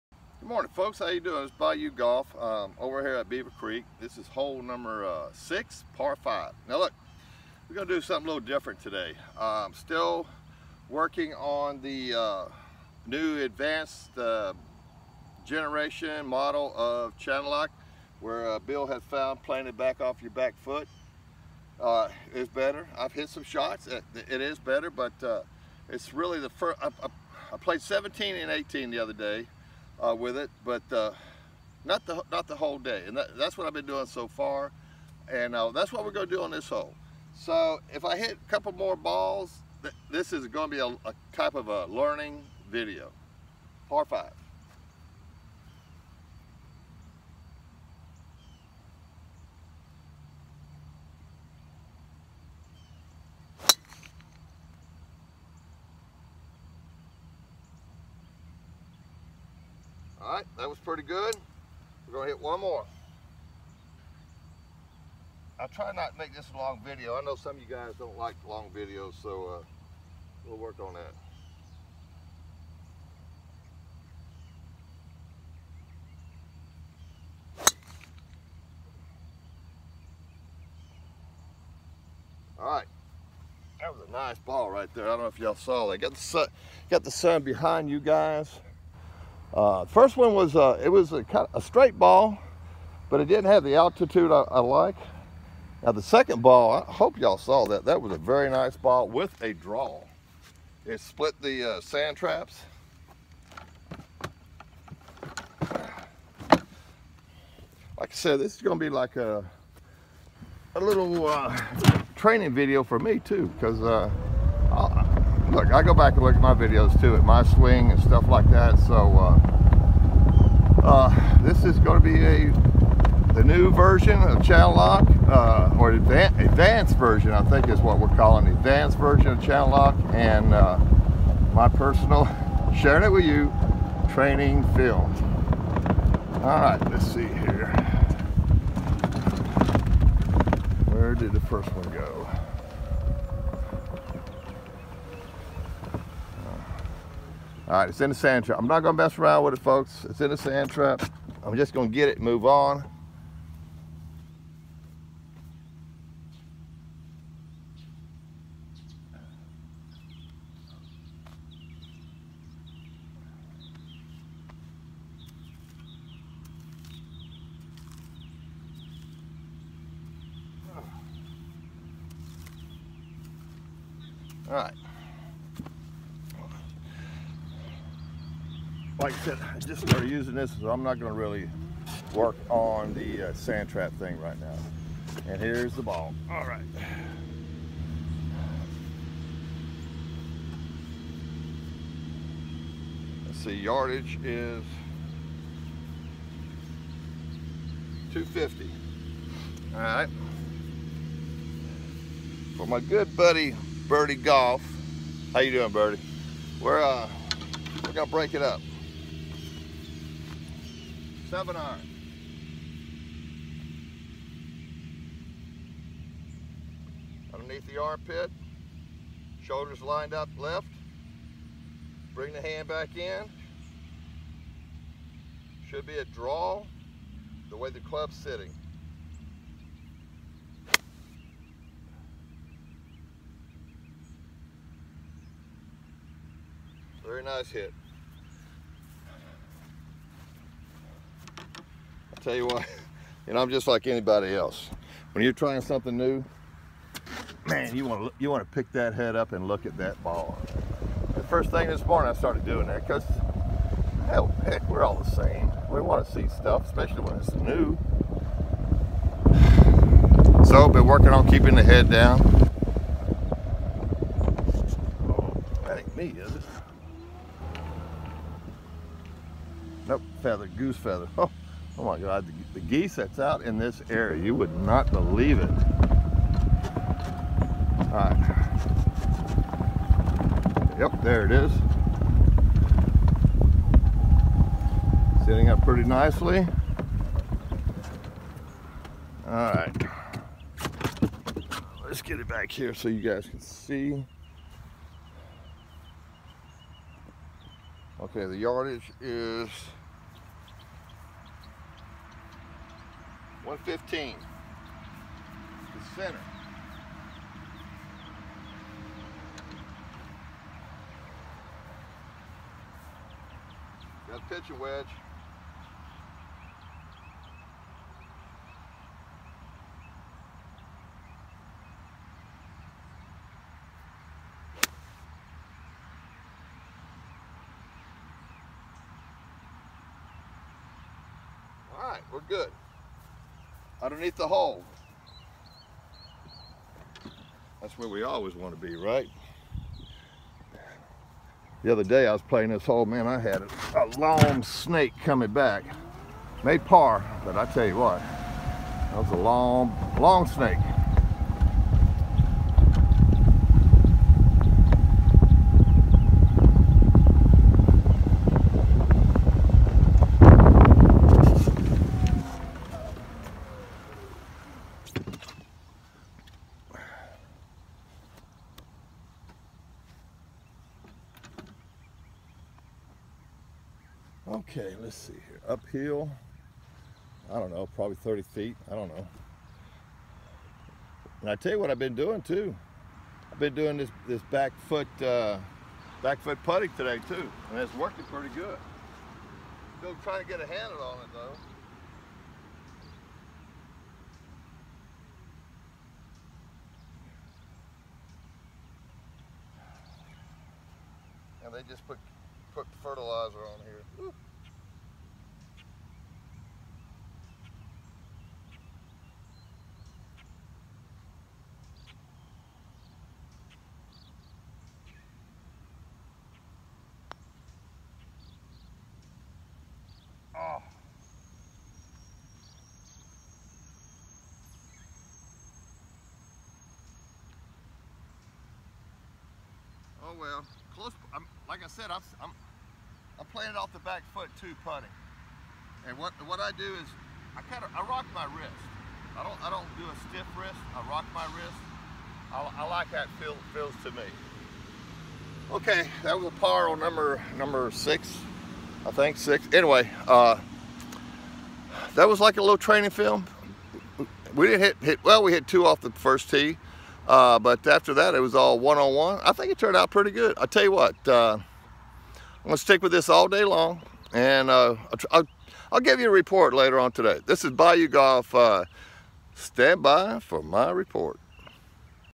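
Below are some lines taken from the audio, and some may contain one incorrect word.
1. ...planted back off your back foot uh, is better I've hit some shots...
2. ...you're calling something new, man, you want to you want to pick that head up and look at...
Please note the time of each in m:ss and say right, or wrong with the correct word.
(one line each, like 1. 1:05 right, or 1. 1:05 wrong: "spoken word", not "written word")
1. 0:19 right
2. 4:05 wrong: "trying", not "calling".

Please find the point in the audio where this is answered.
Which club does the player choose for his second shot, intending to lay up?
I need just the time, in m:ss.
3:31.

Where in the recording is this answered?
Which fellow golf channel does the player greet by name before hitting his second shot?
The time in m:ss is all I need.
3:23.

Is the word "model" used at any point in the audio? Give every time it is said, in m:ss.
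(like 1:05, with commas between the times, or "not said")
0:16.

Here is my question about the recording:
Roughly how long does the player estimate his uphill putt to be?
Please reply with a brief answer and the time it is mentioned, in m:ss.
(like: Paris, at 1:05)
30 feet, at 6:17.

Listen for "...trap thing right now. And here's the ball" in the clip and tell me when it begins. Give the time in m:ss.
3:03.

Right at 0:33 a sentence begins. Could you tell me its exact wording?
And that, that's what I've been doing so far, and uh, that's what we're going to do on this hole.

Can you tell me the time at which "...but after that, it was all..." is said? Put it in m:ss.
7:37.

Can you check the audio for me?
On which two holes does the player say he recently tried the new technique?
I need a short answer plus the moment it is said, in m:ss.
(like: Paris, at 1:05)
17 and 18, at 0:27.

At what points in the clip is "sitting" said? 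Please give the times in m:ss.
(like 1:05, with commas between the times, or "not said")
3:48, 4:45.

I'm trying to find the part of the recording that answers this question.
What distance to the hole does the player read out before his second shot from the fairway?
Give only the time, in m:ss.
3:18.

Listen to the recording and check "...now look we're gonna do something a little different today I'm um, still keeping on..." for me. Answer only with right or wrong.
wrong.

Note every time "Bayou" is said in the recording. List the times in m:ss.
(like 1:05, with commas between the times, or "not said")
0:01, 7:47.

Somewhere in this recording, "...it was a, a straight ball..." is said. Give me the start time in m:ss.
1:30.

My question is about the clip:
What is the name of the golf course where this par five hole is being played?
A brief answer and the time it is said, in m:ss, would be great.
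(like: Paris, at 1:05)
Beaver Creek, at 0:03.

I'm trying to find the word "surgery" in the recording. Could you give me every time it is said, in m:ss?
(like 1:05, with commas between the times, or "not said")
not said.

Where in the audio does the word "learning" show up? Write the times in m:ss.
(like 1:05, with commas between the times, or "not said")
0:41.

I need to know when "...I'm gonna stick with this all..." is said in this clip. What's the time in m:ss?
7:41.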